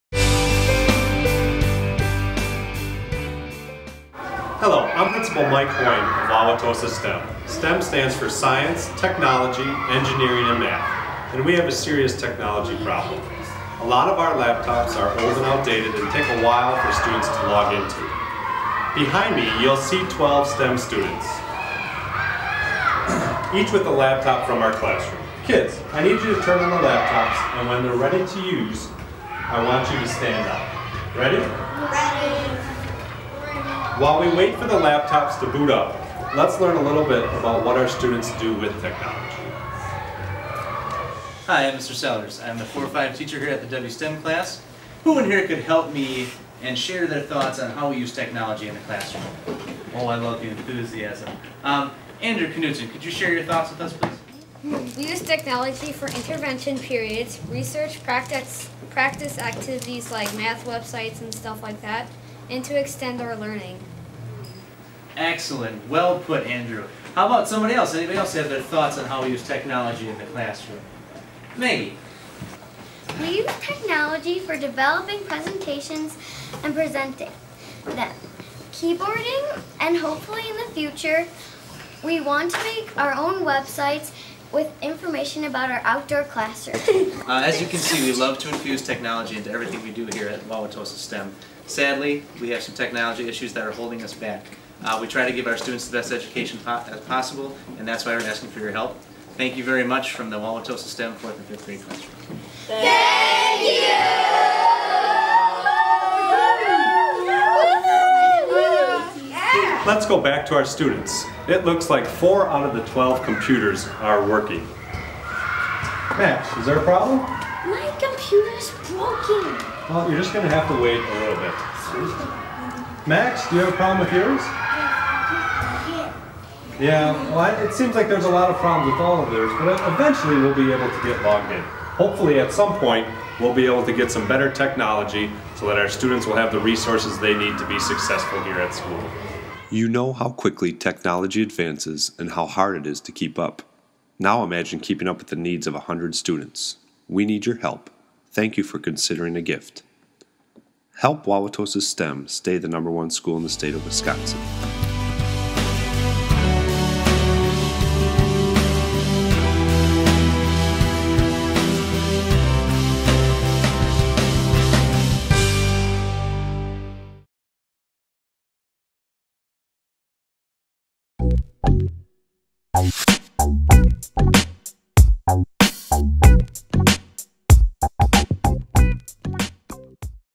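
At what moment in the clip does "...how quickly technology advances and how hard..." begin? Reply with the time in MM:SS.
02:20.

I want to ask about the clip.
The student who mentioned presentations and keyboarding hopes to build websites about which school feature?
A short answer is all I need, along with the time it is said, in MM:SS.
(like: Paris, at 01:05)
Outdoor classroom, at 01:25.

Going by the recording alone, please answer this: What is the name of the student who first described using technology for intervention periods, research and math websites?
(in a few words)
Andrew Knudsen.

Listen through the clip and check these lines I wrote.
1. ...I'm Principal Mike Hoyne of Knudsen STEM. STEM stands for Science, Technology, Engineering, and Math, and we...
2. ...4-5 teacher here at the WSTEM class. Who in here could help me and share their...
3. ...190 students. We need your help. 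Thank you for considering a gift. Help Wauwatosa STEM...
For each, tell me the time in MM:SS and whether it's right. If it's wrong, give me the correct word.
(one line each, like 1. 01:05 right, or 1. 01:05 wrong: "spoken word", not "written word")
1. 00:04 wrong: "Wauwatosa", not "Knudsen"
2. 00:42 right
3. 02:25 wrong: "100", not "190".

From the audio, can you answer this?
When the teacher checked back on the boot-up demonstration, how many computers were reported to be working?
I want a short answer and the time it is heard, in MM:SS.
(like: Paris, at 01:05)
4, at 01:52.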